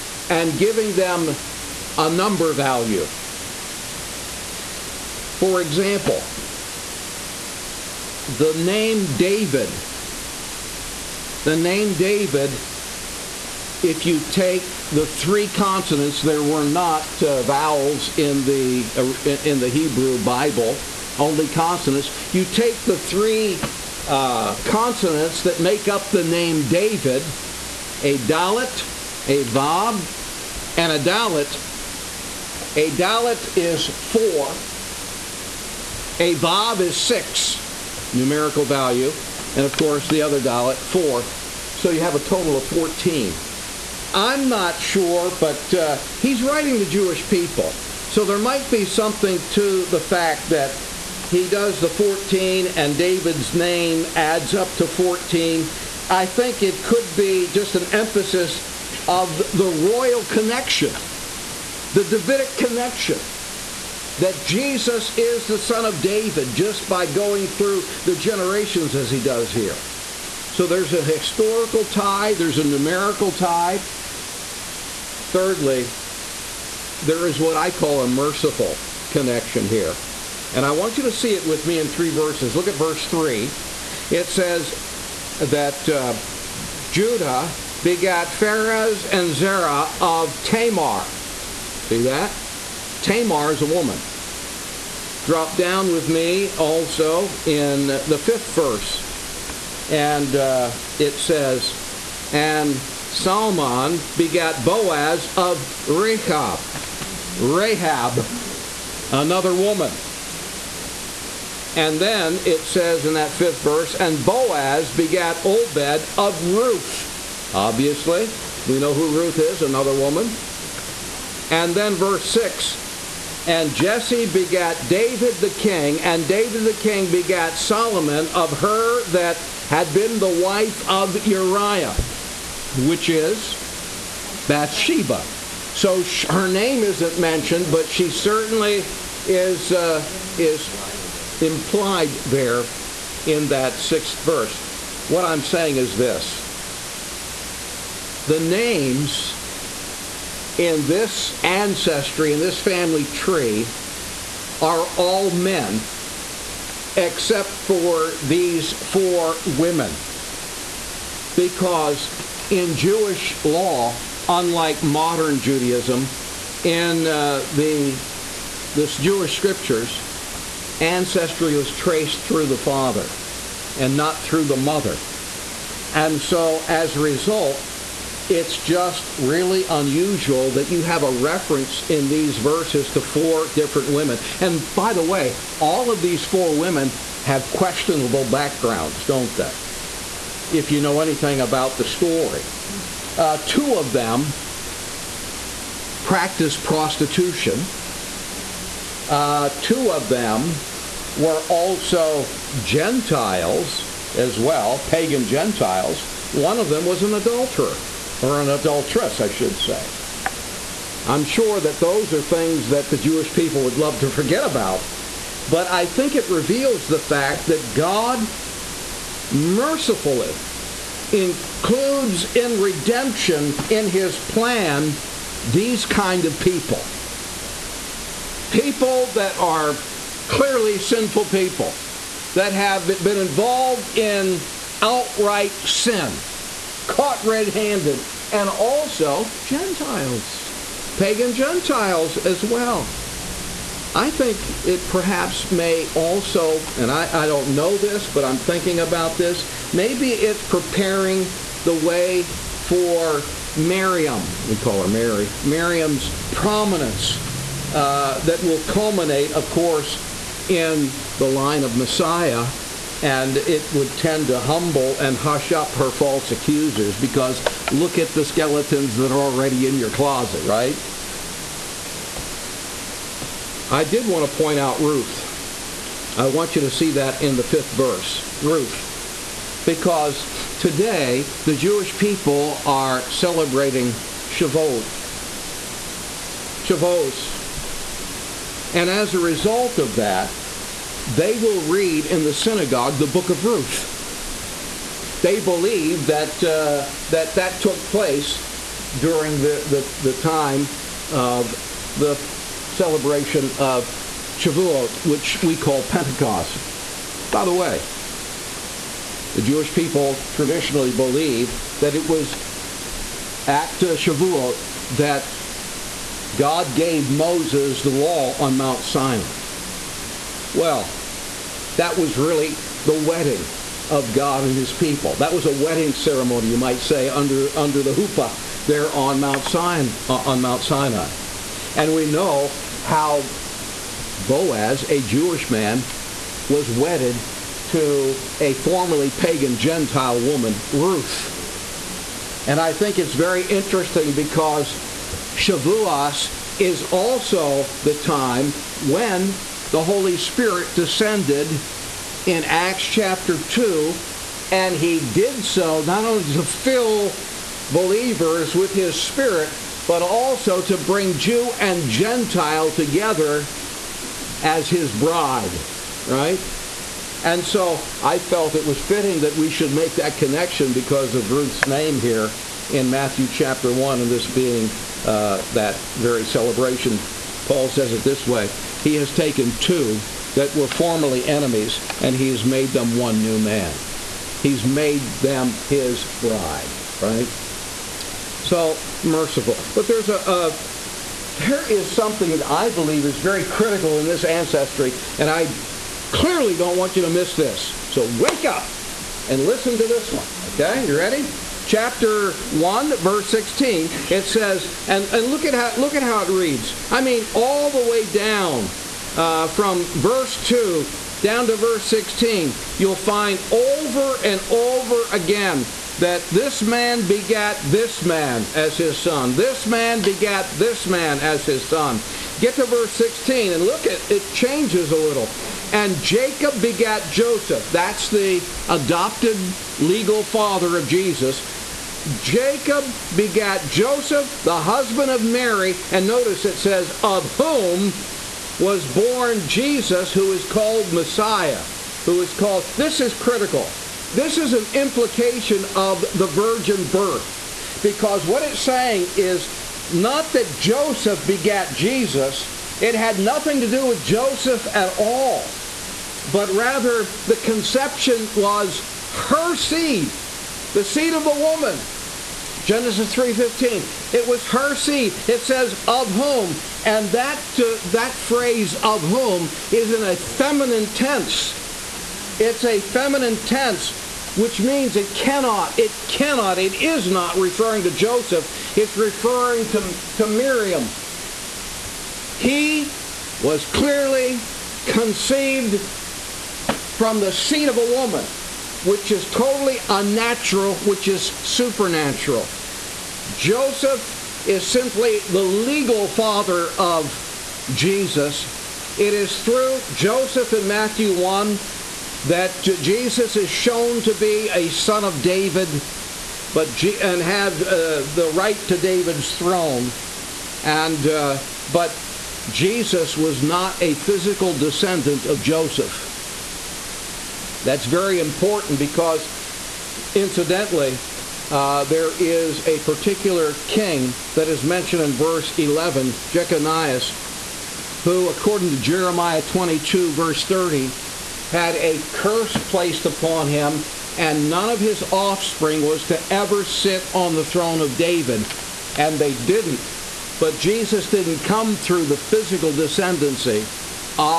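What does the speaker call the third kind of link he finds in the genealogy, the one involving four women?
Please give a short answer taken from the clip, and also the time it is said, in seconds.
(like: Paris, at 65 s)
merciful connection, at 78 s.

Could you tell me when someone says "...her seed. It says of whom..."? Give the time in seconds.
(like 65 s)
464 s.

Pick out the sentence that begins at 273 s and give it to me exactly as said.
I did want to point out Ruth.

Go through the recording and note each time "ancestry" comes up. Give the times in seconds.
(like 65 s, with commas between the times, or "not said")
151 s, 170 s, 394 s.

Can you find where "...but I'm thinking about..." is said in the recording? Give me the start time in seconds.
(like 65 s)
248 s.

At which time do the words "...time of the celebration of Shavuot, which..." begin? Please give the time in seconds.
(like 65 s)
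300 s.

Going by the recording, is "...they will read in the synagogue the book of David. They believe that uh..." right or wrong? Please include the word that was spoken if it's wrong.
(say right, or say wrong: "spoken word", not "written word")
wrong: "Ruth", not "David".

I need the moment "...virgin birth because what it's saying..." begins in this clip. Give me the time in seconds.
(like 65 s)
446 s.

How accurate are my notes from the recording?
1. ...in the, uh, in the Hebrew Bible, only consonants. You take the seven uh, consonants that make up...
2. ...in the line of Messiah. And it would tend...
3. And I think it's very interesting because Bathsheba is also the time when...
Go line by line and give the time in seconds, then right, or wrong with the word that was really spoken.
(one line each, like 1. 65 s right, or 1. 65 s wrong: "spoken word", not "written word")
1. 18 s wrong: "three", not "seven"
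2. 260 s right
3. 342 s wrong: "Shavuos", not "Bathsheba".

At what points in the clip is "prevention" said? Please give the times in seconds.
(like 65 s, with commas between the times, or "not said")
not said.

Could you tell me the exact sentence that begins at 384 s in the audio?
He's made them his bride, right?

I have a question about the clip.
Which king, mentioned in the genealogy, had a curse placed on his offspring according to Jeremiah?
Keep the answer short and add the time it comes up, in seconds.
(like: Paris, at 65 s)
Jeconias, at 526 s.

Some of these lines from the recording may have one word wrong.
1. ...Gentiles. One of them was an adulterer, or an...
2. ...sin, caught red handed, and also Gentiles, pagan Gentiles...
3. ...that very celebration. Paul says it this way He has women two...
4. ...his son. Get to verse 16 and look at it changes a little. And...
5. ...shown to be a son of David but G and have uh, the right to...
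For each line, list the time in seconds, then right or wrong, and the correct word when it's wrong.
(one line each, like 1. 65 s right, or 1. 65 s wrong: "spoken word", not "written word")
1. 205 s right
2. 235 s right
3. 375 s wrong: "taken", not "women"
4. 421 s right
5. 503 s right.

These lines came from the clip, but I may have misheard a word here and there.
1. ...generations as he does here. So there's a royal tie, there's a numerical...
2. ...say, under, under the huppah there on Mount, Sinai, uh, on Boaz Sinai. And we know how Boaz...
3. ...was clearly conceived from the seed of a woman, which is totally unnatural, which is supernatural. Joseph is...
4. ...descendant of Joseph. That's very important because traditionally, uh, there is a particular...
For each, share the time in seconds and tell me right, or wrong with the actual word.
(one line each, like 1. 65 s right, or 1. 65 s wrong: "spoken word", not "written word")
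1. 68 s wrong: "historical", not "royal"
2. 326 s wrong: "Mount", not "Boaz"
3. 483 s right
4. 514 s wrong: "incidentally", not "traditionally".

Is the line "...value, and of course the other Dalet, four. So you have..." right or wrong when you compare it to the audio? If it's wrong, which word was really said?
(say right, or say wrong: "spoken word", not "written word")
right.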